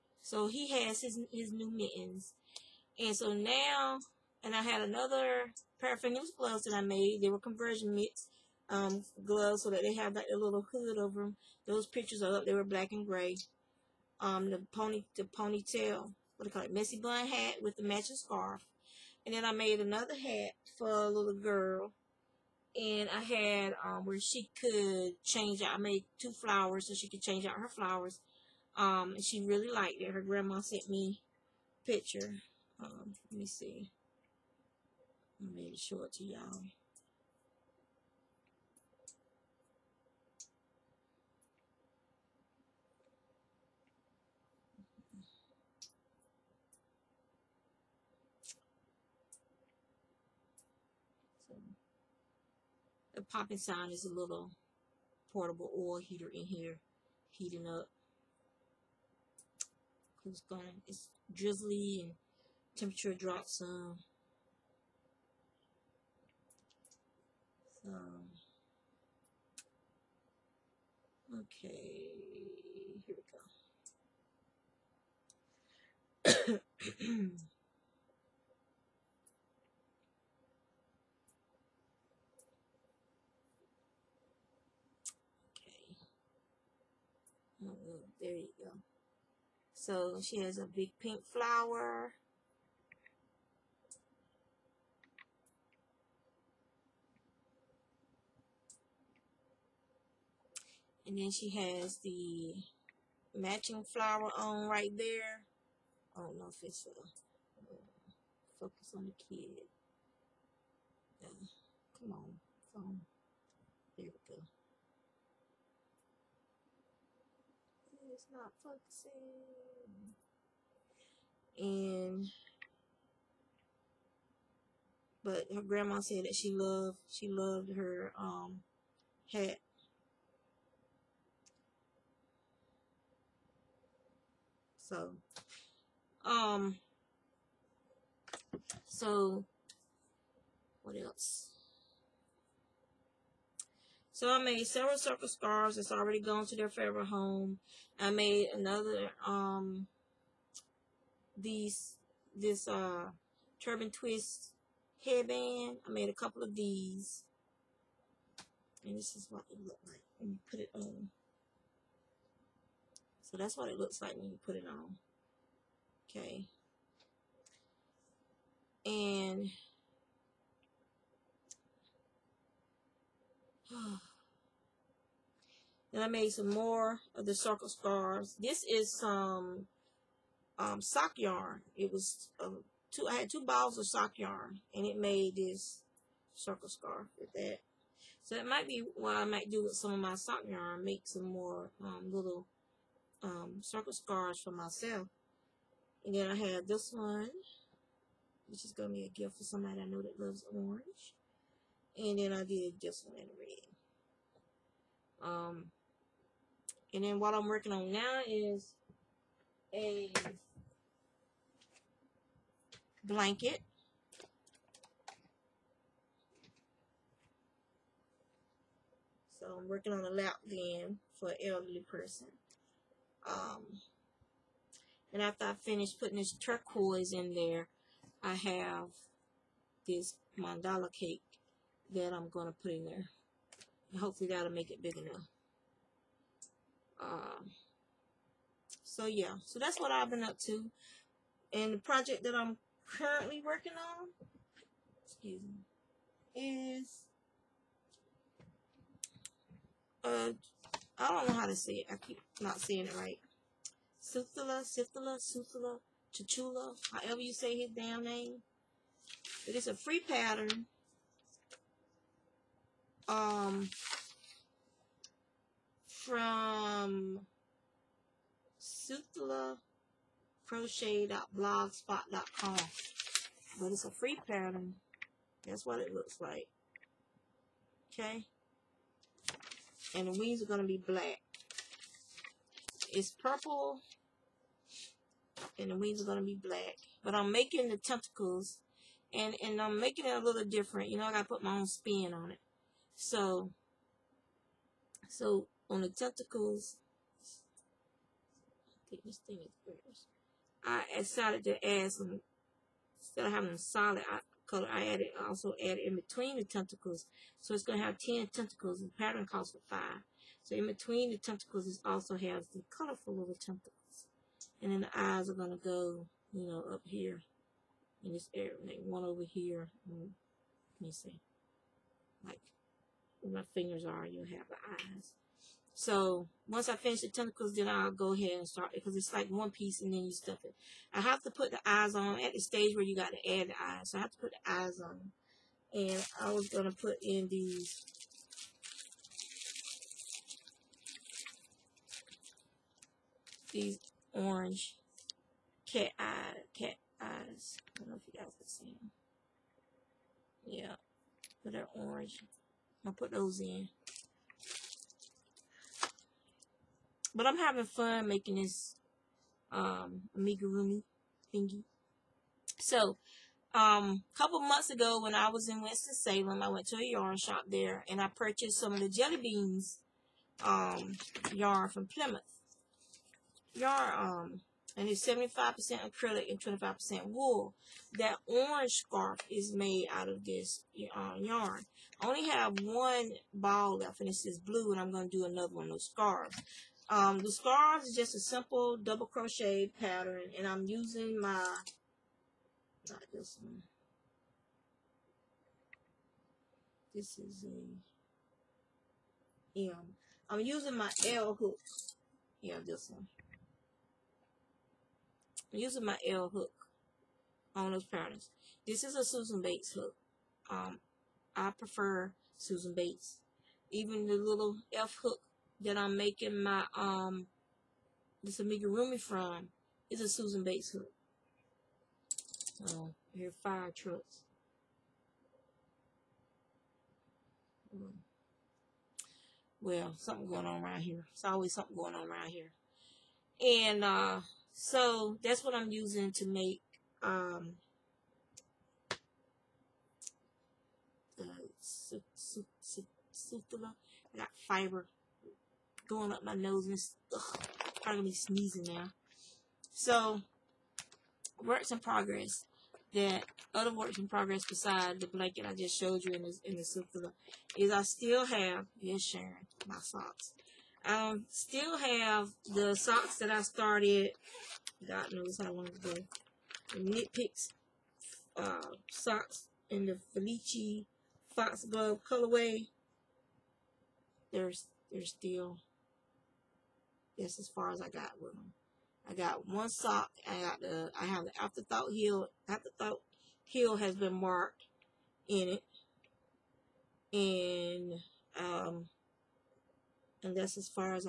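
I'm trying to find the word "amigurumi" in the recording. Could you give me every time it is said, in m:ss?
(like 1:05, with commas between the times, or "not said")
6:00, 6:58.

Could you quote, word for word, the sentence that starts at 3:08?
So that might be what I might do with some of my sock yarn.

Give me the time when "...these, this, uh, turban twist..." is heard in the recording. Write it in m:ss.
2:31.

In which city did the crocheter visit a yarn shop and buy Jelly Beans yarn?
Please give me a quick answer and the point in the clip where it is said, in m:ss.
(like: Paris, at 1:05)
Winston-Salem, at 6:05.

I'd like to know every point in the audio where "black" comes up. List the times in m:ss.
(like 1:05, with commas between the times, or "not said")
0:12, 4:40, 4:46.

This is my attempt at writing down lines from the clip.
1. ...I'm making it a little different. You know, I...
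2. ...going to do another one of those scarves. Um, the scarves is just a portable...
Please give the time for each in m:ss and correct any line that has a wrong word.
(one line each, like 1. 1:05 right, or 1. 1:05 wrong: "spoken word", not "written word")
1. 4:49 right
2. 6:24 wrong: "simple", not "portable".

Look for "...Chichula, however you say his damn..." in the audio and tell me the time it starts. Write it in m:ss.
4:16.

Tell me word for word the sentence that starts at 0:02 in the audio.
And so now, and I had another pair of fingerless gloves that I made.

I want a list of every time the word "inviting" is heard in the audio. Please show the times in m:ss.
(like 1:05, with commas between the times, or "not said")
not said.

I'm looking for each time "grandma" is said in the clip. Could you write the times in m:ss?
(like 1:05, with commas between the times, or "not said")
0:30, 2:05.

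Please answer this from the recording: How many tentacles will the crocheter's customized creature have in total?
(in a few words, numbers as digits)
10.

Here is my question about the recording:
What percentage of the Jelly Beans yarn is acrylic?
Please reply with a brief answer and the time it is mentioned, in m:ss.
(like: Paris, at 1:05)
75%, at 6:15.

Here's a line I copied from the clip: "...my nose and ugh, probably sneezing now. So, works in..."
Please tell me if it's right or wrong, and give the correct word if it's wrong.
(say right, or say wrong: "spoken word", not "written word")
right.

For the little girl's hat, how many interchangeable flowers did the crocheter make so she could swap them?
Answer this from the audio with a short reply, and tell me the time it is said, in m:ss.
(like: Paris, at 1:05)
2, at 0:26.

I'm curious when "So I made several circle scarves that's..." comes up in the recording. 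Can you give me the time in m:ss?
2:24.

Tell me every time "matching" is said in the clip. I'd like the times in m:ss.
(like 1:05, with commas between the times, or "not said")
0:17, 1:43.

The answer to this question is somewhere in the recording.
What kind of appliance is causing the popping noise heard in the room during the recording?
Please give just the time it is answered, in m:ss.
0:55.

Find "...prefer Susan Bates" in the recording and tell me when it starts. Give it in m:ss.
6:51.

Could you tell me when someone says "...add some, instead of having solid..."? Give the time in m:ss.
5:01.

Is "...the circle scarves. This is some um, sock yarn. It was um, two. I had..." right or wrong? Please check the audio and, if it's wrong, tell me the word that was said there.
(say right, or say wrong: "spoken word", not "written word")
right.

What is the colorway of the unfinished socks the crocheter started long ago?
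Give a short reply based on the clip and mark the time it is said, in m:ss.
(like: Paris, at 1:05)
Foxglove, at 7:50.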